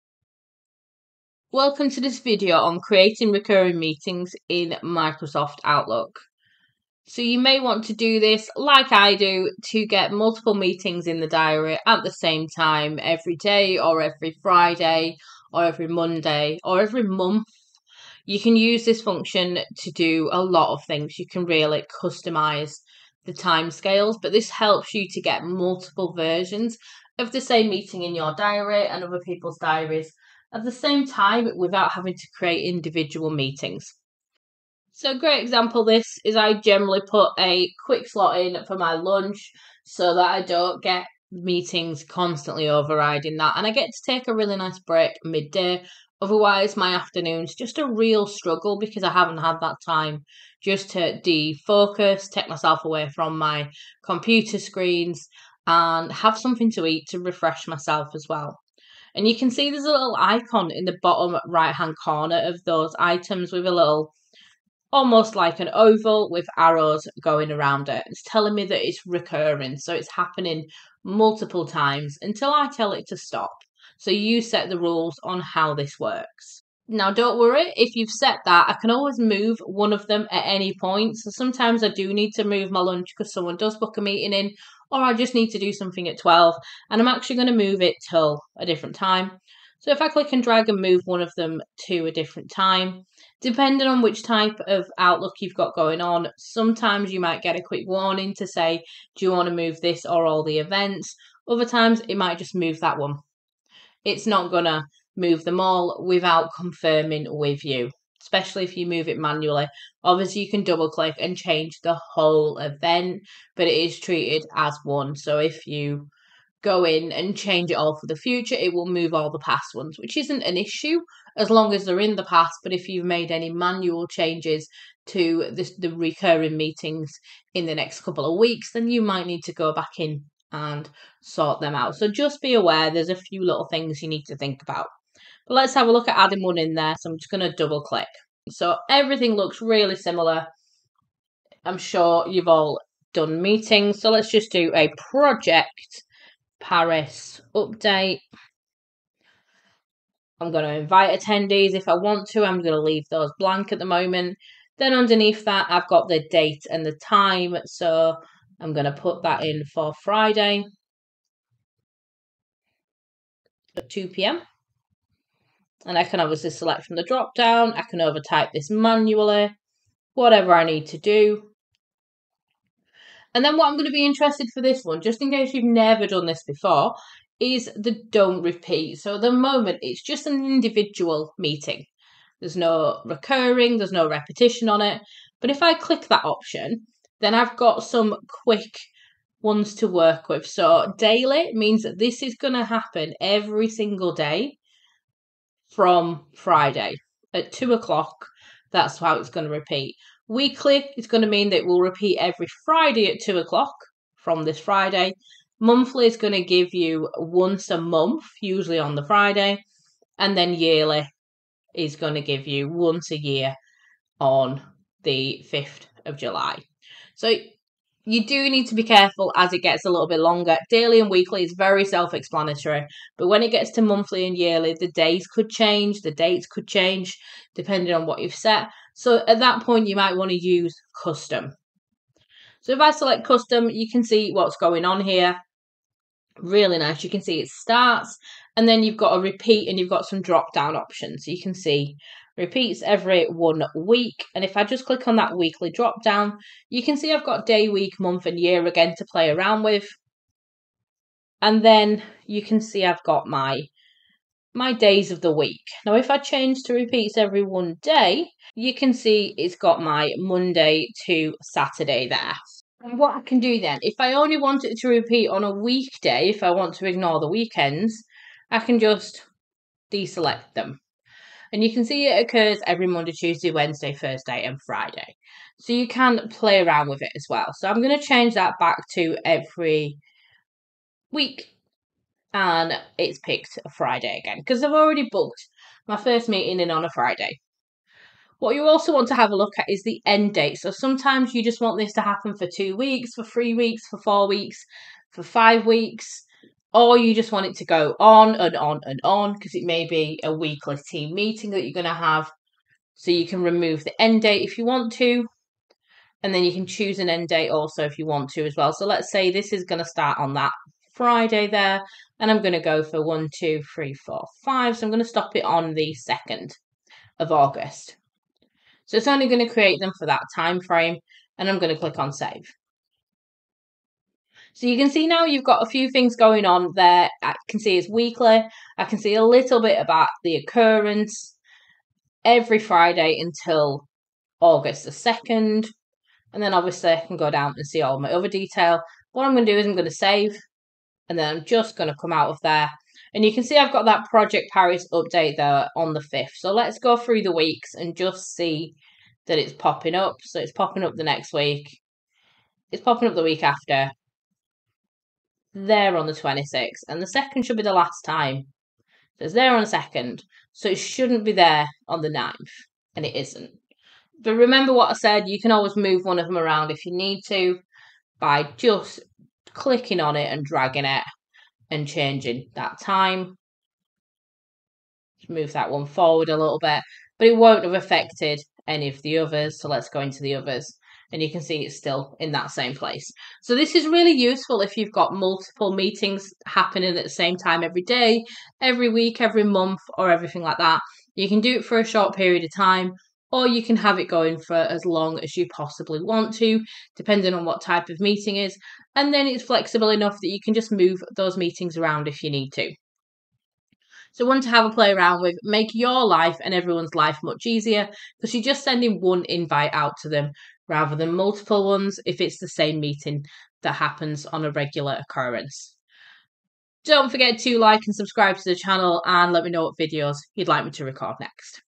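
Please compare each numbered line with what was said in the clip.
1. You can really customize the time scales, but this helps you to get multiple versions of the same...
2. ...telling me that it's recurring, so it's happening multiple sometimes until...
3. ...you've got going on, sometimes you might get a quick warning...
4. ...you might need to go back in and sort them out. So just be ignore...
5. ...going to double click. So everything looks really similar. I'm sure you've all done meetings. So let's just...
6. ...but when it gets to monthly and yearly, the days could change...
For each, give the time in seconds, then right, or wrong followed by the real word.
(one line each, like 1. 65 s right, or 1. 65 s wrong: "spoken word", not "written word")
1. 21 s right
2. 68 s wrong: "times", not "sometimes"
3. 95 s right
4. 128 s wrong: "aware", not "ignore"
5. 137 s right
6. 223 s right.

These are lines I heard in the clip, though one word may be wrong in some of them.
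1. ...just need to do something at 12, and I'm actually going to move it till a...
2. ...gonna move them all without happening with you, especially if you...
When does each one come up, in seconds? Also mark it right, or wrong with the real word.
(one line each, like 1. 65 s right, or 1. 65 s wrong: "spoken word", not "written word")
1. 85 s right
2. 104 s wrong: "confirming", not "happening".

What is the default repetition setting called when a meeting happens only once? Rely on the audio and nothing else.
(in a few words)
Don't repeat.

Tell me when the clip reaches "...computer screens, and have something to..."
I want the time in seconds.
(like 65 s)
54 s.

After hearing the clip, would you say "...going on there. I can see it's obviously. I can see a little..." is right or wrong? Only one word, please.
wrong.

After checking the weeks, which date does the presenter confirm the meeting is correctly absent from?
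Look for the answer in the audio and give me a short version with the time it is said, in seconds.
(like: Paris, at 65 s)
The 9th, at 362 s.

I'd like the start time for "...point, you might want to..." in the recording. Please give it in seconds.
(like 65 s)
229 s.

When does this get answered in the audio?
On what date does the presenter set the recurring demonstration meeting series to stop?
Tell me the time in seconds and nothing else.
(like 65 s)
316 s.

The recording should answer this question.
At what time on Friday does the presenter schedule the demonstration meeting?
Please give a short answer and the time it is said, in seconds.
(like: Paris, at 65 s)
2 p.m., at 163 s.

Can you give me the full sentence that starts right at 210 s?
And then yearly is going to give you once a year on the 5th of July.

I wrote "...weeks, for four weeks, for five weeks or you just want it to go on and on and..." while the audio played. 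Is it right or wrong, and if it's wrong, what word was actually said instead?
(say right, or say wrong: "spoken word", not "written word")
right.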